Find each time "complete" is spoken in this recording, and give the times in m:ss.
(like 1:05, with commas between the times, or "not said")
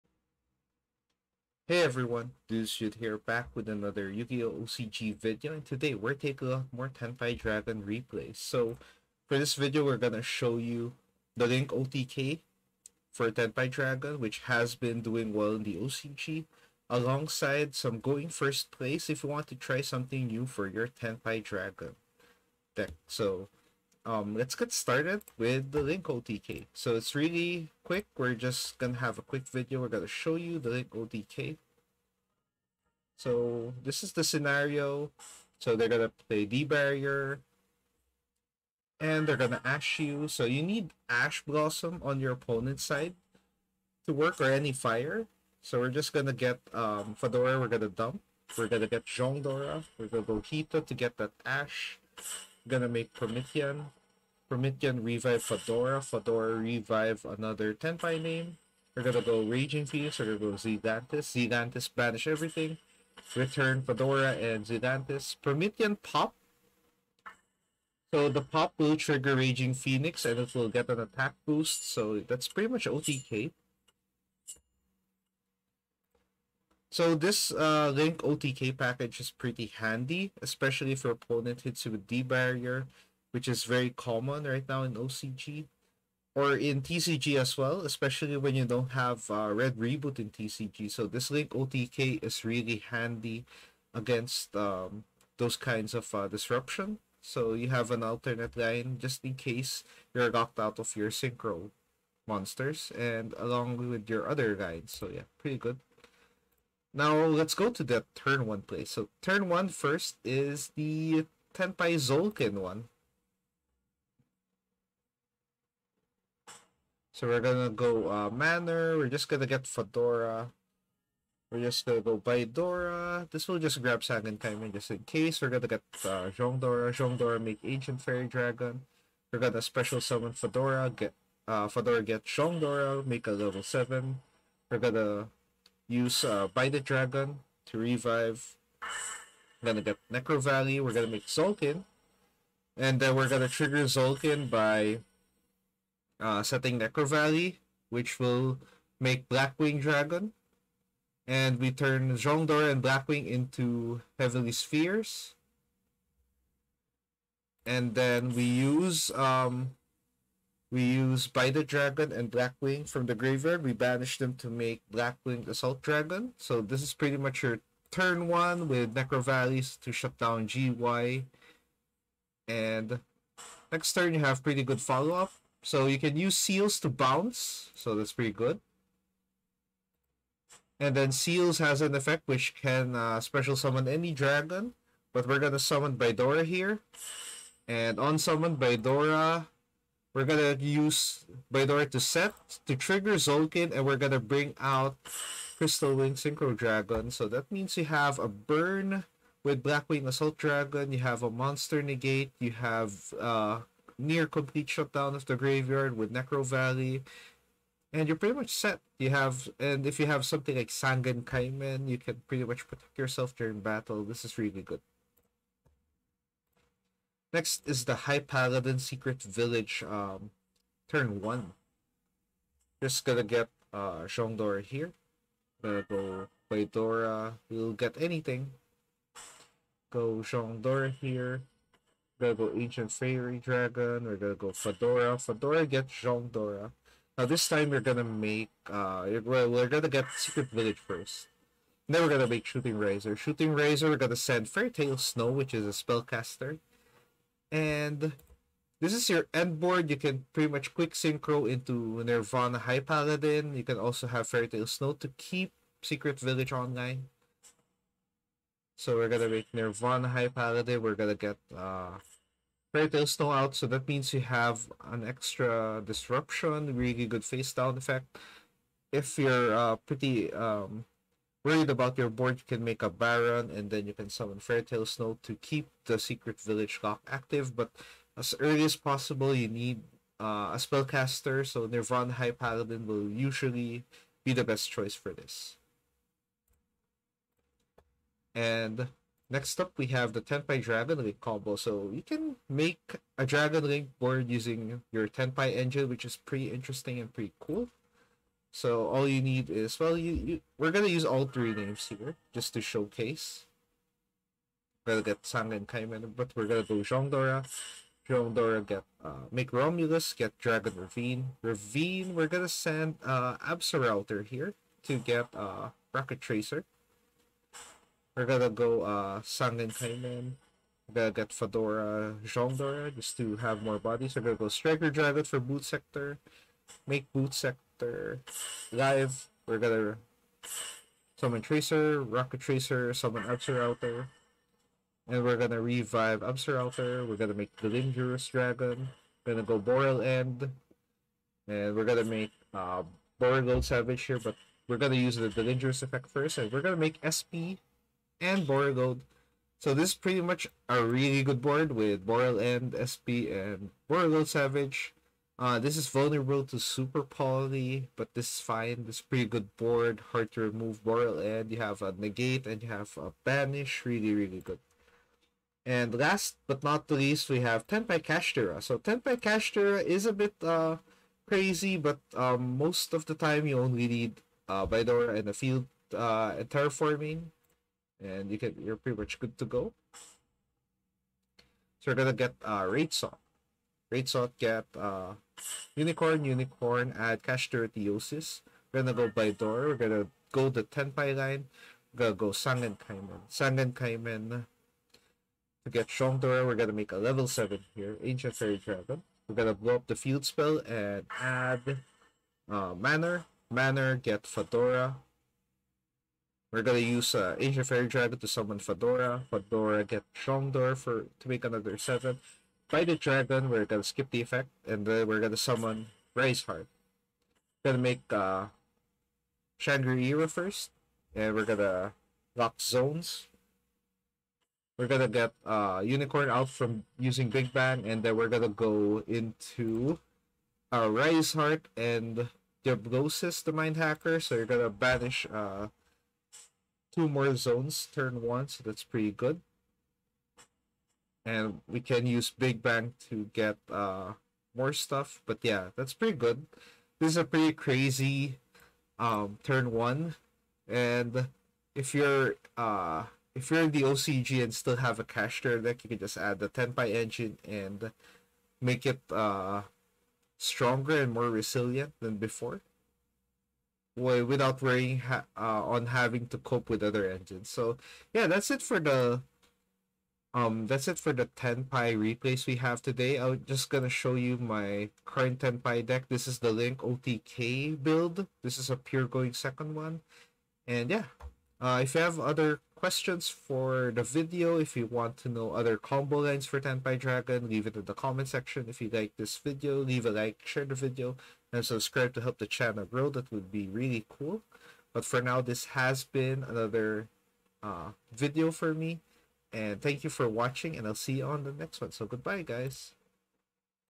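3:24.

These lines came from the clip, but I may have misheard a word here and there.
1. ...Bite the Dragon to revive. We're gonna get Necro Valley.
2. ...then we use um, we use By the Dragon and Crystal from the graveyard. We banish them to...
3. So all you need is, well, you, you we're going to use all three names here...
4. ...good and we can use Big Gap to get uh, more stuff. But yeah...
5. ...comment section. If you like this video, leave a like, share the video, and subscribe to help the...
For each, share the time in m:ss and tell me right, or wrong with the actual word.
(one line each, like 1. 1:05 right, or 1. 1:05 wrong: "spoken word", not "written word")
1. 2:16 right
2. 2:37 wrong: "Blackwing", not "Crystal"
3. 4:58 right
4. 7:19 wrong: "Bang", not "Gap"
5. 8:07 right.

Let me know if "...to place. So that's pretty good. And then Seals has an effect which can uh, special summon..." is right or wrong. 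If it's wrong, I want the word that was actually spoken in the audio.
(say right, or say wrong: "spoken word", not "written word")
wrong: "bounce", not "place".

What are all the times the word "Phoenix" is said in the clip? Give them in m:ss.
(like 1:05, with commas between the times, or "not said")
0:59, 1:09.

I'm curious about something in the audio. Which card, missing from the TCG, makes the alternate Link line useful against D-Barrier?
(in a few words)
Red Reboot.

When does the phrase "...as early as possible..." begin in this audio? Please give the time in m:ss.
4:38.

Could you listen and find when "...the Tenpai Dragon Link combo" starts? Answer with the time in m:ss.
4:50.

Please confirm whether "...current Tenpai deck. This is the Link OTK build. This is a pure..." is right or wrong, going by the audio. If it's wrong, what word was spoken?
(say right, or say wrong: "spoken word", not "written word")
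right.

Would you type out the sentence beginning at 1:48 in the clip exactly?
So turn one first is the Tenpai Zolkin one.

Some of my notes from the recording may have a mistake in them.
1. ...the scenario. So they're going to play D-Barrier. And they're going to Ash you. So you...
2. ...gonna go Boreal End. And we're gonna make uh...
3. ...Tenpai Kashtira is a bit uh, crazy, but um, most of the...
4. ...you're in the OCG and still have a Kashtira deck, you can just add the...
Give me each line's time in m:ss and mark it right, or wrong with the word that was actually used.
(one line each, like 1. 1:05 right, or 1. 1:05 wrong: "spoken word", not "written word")
1. 0:34 right
2. 5:39 right
3. 6:08 right
4. 7:33 right.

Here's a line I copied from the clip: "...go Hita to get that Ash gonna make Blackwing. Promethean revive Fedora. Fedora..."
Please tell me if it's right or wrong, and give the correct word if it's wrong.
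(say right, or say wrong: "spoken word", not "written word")
wrong: "Promethean", not "Blackwing".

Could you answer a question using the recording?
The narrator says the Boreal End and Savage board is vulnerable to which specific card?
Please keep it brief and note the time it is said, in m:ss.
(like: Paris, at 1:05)
Super Poly, at 5:56.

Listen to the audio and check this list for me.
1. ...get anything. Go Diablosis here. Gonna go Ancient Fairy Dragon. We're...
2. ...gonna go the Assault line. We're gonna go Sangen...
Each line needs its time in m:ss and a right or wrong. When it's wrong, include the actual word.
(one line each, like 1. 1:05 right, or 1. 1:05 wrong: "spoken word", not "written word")
1. 3:47 wrong: "Shongdor", not "Diablosis"
2. 6:29 wrong: "Tenpai", not "Assault".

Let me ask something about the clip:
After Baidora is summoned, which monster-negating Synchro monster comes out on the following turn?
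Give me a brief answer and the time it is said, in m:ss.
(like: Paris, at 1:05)
Crystal Wing Synchro Dragon, at 3:15.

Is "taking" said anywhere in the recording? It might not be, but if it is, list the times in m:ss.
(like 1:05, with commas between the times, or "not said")
0:06.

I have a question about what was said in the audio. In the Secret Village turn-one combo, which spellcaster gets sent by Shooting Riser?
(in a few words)
Fairy Tale Snow.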